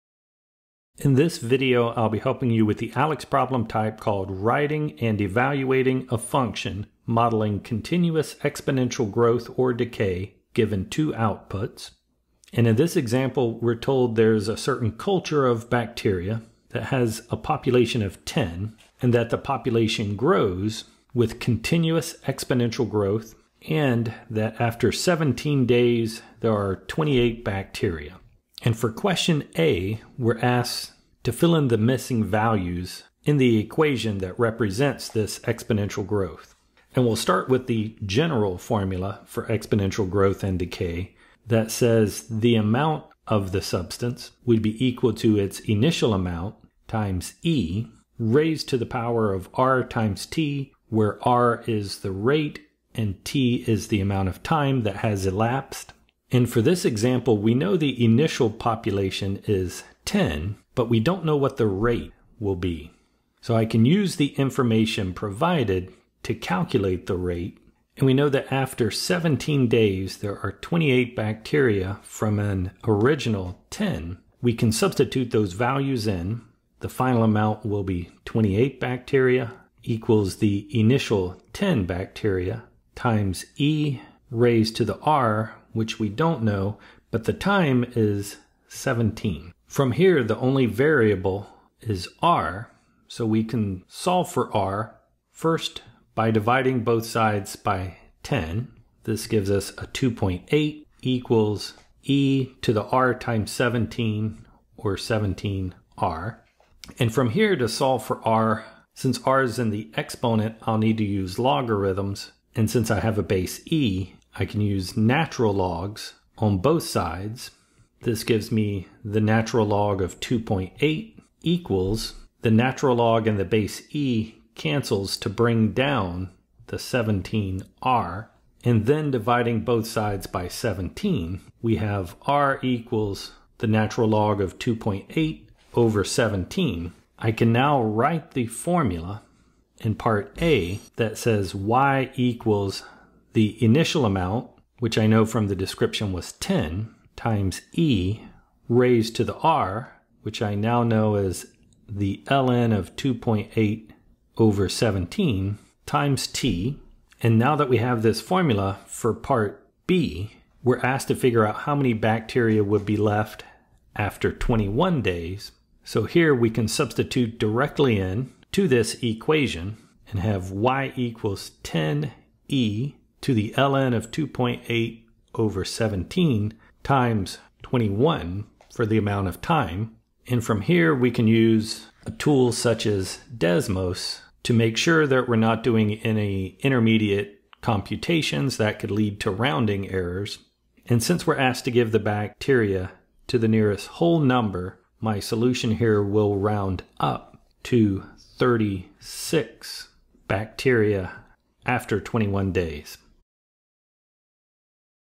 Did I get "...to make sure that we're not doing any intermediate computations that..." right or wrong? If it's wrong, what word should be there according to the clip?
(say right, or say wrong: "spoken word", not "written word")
right.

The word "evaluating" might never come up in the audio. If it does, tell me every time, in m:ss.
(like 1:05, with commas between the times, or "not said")
0:05.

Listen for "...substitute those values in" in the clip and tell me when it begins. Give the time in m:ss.
1:14.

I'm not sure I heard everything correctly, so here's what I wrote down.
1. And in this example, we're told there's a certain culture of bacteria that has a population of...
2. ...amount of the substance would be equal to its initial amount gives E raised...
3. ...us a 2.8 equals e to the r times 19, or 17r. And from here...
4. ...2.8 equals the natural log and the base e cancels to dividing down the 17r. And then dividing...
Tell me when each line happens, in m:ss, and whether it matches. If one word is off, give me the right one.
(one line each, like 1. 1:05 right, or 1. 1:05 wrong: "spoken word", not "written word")
1. 0:12 right
2. 0:42 wrong: "times", not "gives"
3. 1:39 wrong: "17", not "19"
4. 2:00 wrong: "bring", not "dividing".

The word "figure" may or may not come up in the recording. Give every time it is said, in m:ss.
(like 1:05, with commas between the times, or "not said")
2:41.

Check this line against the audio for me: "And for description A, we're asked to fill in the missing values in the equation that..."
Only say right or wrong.
wrong.